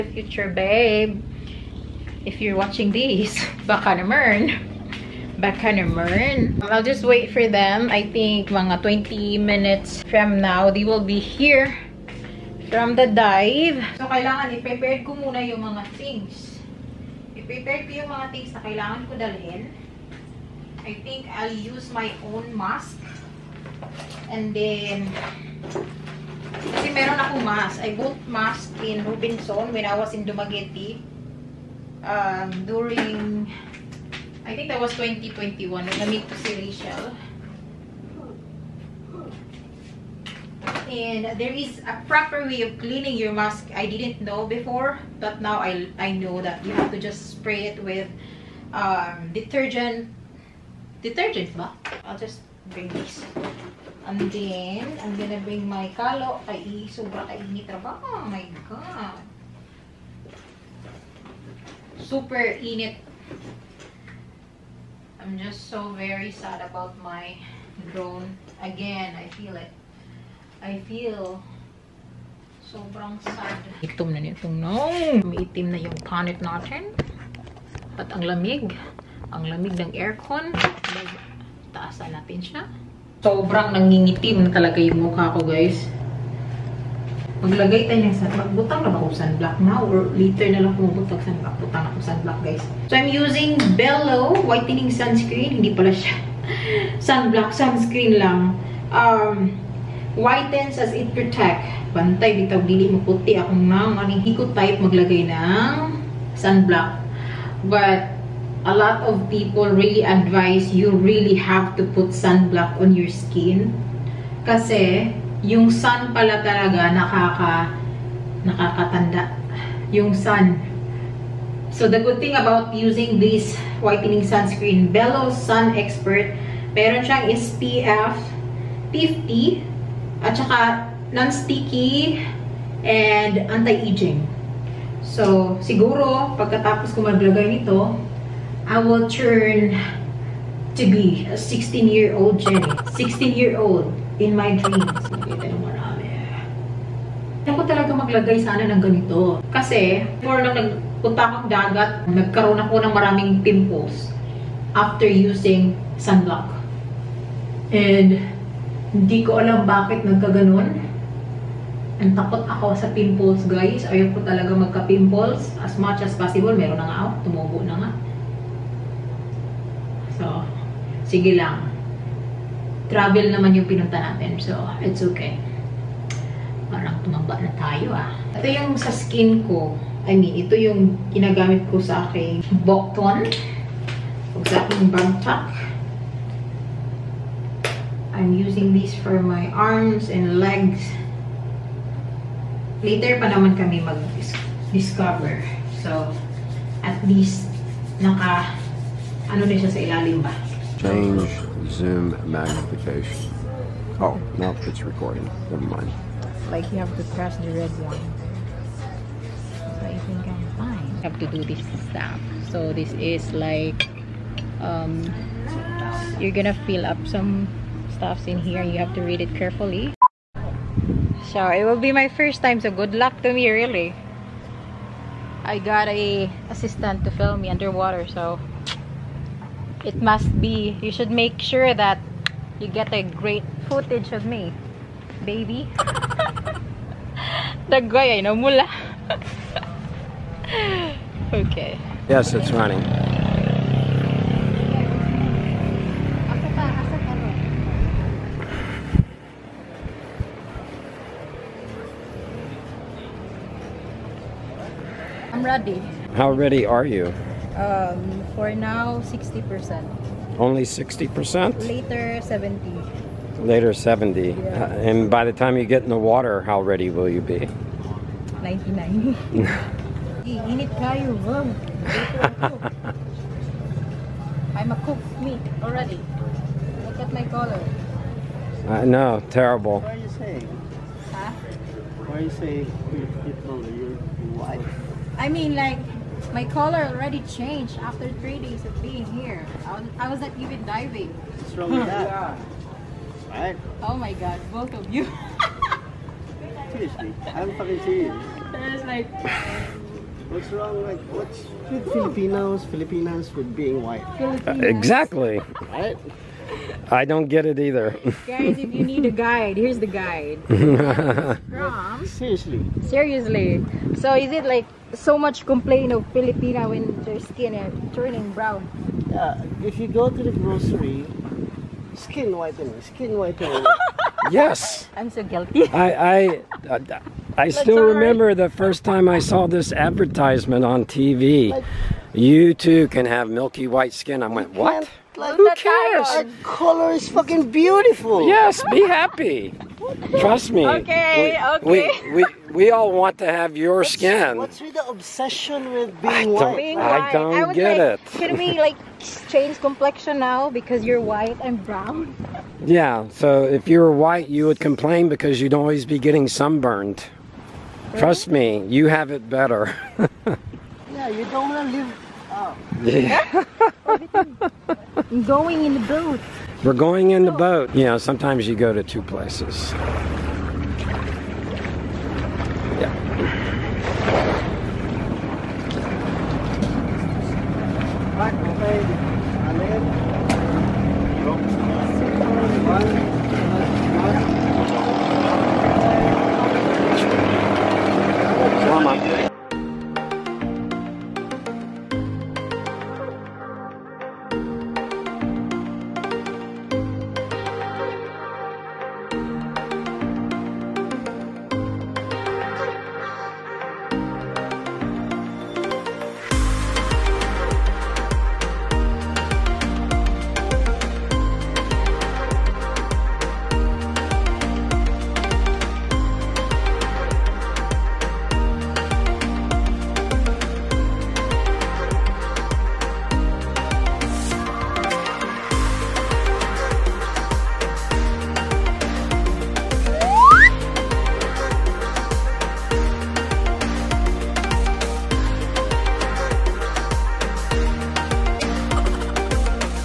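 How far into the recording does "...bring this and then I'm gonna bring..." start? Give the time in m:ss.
0:52.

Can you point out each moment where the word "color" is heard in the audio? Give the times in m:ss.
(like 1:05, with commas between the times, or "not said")
4:37, 4:46, 5:36.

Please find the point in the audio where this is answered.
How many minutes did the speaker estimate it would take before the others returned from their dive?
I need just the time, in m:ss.
0:08.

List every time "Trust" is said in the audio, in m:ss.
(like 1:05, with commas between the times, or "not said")
5:40, 5:57.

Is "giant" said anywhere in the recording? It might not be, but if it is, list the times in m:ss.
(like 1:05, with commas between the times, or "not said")
not said.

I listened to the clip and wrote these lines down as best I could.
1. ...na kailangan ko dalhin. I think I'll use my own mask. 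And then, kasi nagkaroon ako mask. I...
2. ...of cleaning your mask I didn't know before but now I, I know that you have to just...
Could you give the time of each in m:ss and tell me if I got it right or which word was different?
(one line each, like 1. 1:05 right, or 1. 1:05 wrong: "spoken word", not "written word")
1. 0:18 wrong: "meron", not "nagkaroon"
2. 0:42 right.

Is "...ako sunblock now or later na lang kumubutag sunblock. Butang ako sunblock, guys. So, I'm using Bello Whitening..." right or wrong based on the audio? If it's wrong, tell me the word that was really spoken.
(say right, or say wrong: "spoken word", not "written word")
right.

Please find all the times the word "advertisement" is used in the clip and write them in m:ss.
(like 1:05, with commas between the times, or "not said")
5:29.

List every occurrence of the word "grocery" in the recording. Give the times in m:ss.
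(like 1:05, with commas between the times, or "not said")
5:20.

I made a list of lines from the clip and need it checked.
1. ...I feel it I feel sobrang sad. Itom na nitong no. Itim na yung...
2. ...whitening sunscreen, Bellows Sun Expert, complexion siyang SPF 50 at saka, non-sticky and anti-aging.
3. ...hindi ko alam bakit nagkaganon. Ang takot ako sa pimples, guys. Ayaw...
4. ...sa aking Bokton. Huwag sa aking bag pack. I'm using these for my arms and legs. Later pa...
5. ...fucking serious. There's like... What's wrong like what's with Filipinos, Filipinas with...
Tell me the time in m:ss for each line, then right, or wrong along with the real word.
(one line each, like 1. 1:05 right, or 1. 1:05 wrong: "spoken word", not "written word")
1. 1:09 right
2. 2:03 wrong: "meron", not "complexion"
3. 2:38 right
4. 3:01 right
5. 4:57 right.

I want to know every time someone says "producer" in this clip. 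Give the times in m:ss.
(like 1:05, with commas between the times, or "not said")
not said.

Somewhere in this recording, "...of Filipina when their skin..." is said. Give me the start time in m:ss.
5:15.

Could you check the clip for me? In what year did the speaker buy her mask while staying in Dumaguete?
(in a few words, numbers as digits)
2021.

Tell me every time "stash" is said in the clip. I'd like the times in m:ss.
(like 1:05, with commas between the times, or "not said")
not said.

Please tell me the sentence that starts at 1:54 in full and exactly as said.
Kasi, yung sun pala talaga nakaka, nakakatanda.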